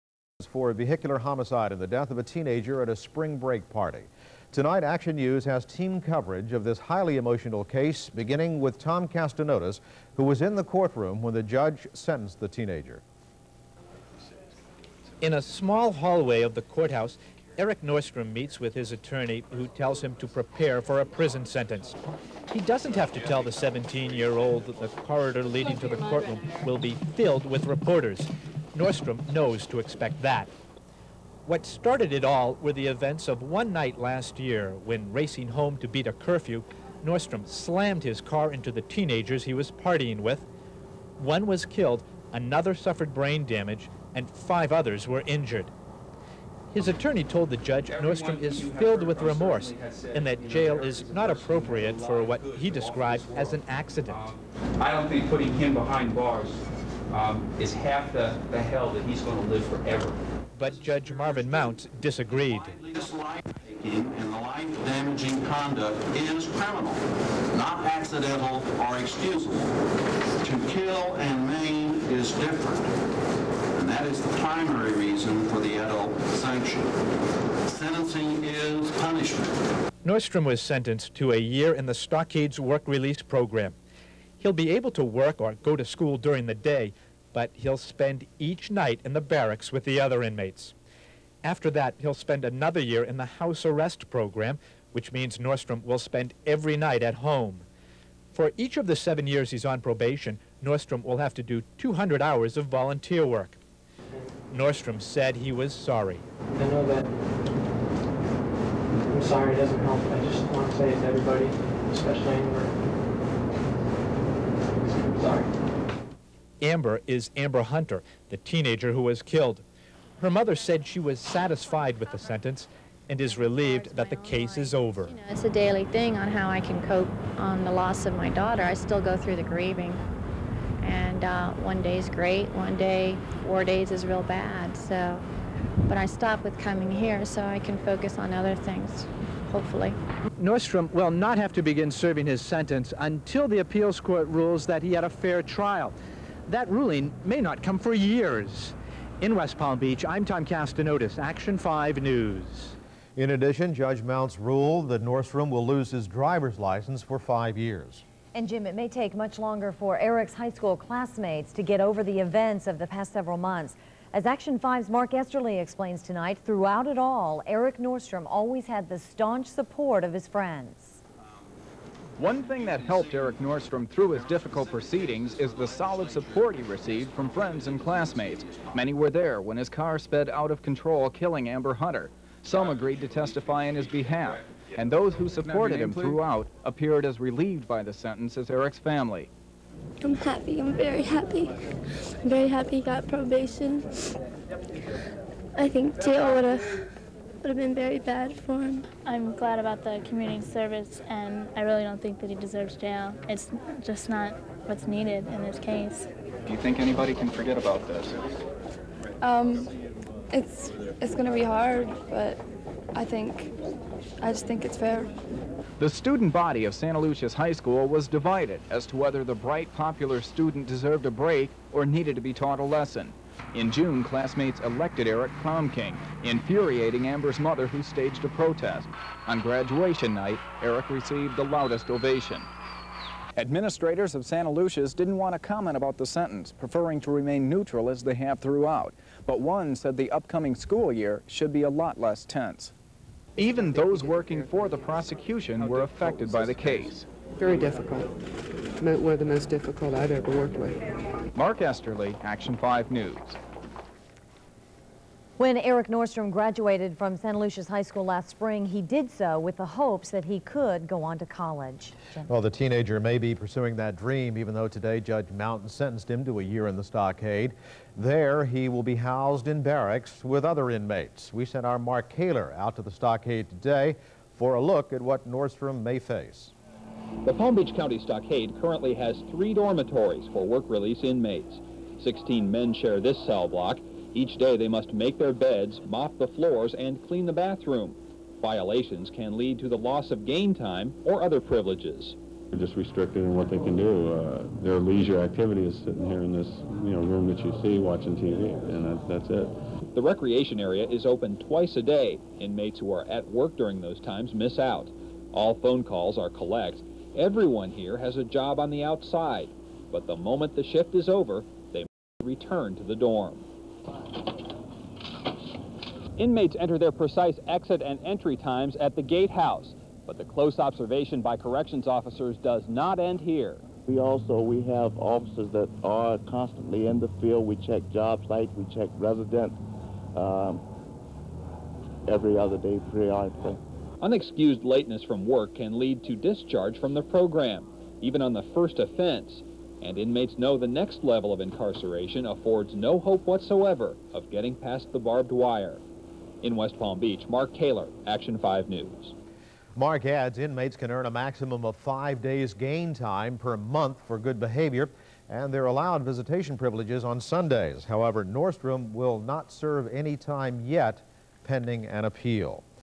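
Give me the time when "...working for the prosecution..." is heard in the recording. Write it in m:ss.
4:04.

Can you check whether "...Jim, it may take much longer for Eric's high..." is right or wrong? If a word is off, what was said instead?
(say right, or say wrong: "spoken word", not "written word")
right.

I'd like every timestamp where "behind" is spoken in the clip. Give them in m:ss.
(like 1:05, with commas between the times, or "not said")
0:55.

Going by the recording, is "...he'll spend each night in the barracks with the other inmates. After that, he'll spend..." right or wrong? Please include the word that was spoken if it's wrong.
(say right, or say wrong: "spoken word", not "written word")
right.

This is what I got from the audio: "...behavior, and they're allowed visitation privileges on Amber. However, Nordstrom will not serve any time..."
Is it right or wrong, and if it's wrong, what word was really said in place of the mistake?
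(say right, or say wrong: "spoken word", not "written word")
wrong: "Sundays", not "Amber".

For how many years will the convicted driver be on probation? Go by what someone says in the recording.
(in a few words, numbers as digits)
7.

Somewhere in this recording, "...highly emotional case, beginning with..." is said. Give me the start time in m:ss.
0:06.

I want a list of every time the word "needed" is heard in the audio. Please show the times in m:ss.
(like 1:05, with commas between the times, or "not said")
3:24, 3:41.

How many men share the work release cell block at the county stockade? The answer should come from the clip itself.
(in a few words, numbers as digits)
16.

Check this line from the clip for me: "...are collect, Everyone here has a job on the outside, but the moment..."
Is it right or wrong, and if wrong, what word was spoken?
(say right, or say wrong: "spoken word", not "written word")
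right.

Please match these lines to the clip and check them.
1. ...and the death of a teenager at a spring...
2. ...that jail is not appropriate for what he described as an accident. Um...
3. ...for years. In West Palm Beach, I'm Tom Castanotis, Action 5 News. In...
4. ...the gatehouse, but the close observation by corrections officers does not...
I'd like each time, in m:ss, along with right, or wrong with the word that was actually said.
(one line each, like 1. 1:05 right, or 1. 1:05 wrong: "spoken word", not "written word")
1. 0:01 right
2. 0:50 right
3. 2:27 right
4. 5:18 right.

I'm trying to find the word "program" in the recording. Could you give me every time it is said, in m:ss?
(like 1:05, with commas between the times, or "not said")
1:23, 1:34, 5:37.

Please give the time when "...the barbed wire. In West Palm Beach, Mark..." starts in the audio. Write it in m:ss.
5:44.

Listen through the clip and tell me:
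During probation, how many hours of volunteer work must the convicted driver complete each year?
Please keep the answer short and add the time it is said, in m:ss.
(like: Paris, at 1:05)
200, at 1:41.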